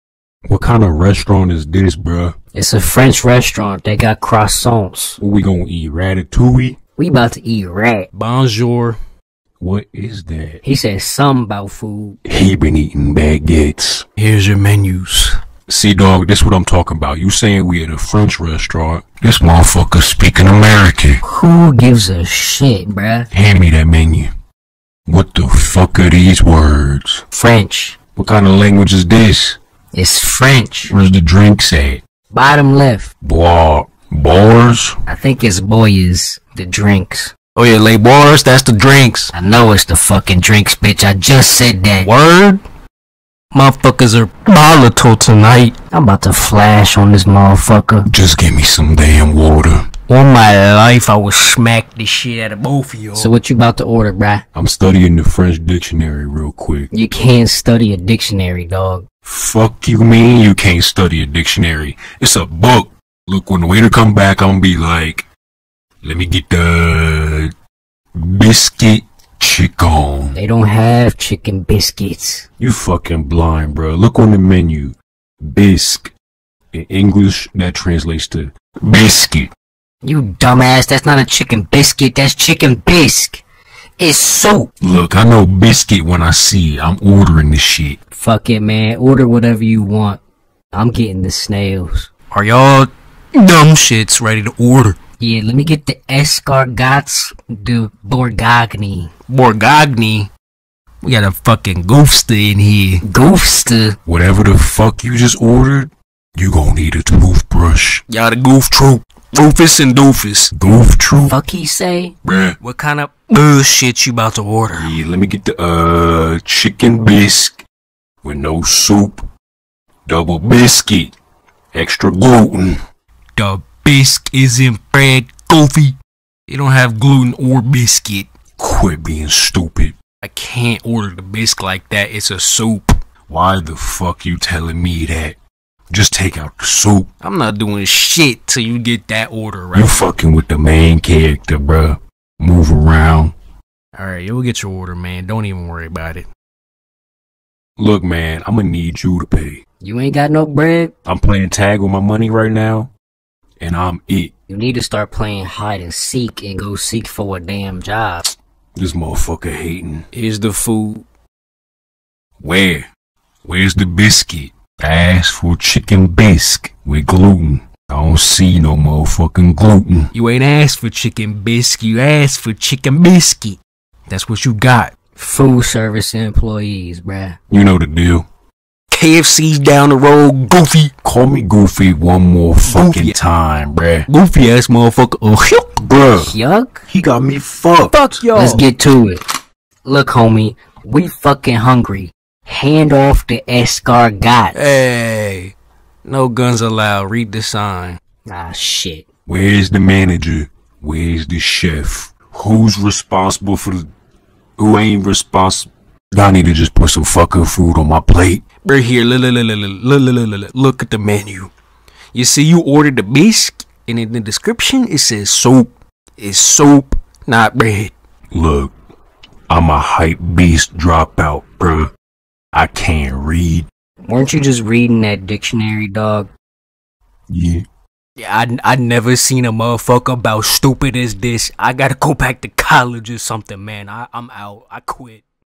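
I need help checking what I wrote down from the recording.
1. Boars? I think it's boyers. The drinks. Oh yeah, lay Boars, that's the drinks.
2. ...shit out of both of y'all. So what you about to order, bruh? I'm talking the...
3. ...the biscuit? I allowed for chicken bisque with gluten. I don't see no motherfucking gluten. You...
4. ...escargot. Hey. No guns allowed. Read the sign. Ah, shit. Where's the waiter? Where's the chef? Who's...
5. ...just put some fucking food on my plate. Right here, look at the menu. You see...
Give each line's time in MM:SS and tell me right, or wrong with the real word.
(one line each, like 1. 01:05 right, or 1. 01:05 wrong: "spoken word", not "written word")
1. 00:34 right
2. 00:52 wrong: "studying", not "talking"
3. 02:43 wrong: "asked", not "allowed"
4. 03:13 wrong: "manager", not "waiter"
5. 03:26 right.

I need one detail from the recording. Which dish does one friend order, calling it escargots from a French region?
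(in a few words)
escargots de Borgogni.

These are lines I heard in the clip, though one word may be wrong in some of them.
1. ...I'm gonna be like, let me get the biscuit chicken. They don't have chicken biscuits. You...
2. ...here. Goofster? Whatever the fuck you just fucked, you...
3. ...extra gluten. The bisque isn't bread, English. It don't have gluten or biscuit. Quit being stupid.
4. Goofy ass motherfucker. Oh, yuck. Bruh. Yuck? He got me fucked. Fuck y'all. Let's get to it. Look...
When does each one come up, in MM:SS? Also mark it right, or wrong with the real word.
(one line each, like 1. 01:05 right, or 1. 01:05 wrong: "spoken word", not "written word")
1. 01:04 right
2. 01:42 wrong: "ordered", not "fucked"
3. 02:01 wrong: "Goofy", not "English"
4. 03:04 right.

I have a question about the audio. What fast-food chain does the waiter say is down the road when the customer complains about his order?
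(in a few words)
KFC.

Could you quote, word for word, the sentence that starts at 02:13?
Why the fuck you telling me that?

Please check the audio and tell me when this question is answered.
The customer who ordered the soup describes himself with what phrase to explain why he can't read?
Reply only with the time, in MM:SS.
03:39.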